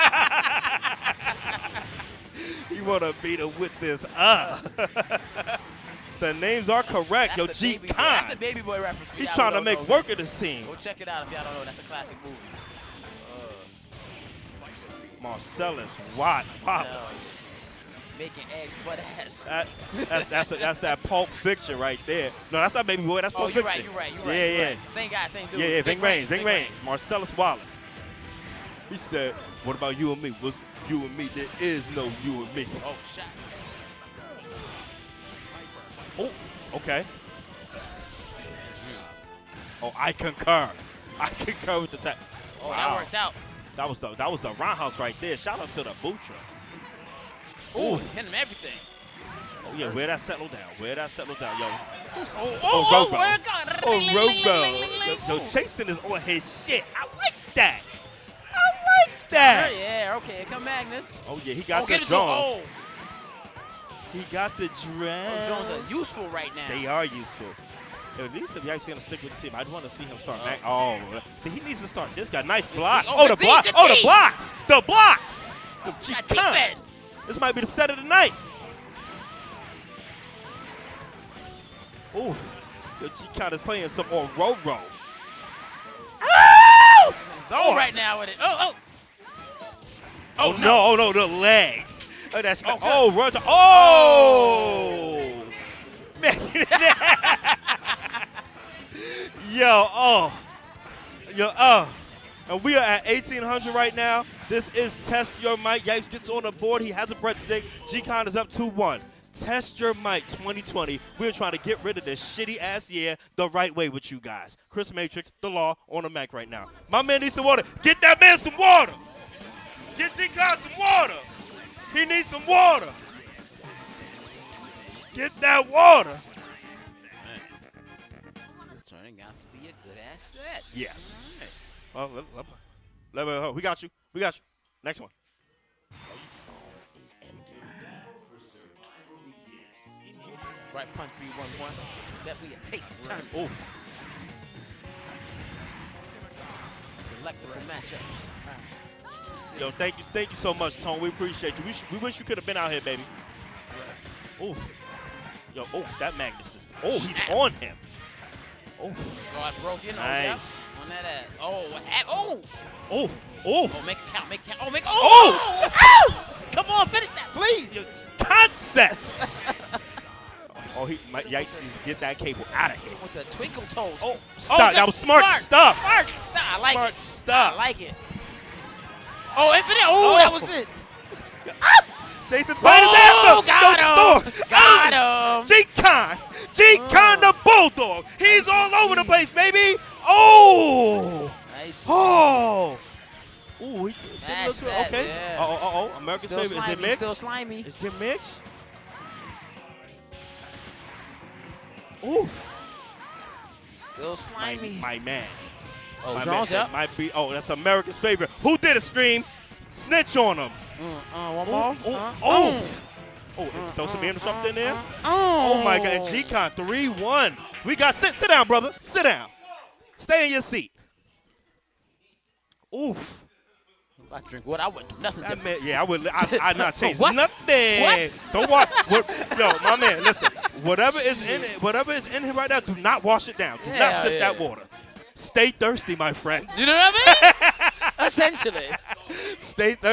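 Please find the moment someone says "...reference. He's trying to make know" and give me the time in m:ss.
0:08.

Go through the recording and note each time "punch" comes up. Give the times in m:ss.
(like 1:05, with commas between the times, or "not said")
2:20.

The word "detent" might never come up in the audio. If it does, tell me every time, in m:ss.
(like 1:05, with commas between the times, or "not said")
not said.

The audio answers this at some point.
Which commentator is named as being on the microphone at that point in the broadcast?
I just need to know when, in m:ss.
1:54.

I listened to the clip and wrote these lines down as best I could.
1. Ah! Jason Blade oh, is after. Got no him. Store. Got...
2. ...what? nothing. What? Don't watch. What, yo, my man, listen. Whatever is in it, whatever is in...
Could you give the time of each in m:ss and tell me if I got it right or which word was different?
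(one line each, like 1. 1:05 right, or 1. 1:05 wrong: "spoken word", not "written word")
1. 3:01 right
2. 3:46 right.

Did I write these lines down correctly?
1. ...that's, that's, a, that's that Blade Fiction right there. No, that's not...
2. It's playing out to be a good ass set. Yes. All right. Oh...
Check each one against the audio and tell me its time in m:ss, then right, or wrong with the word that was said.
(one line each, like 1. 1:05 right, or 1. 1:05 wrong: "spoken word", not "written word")
1. 0:20 wrong: "Pulp", not "Blade"
2. 2:08 wrong: "turning", not "playing".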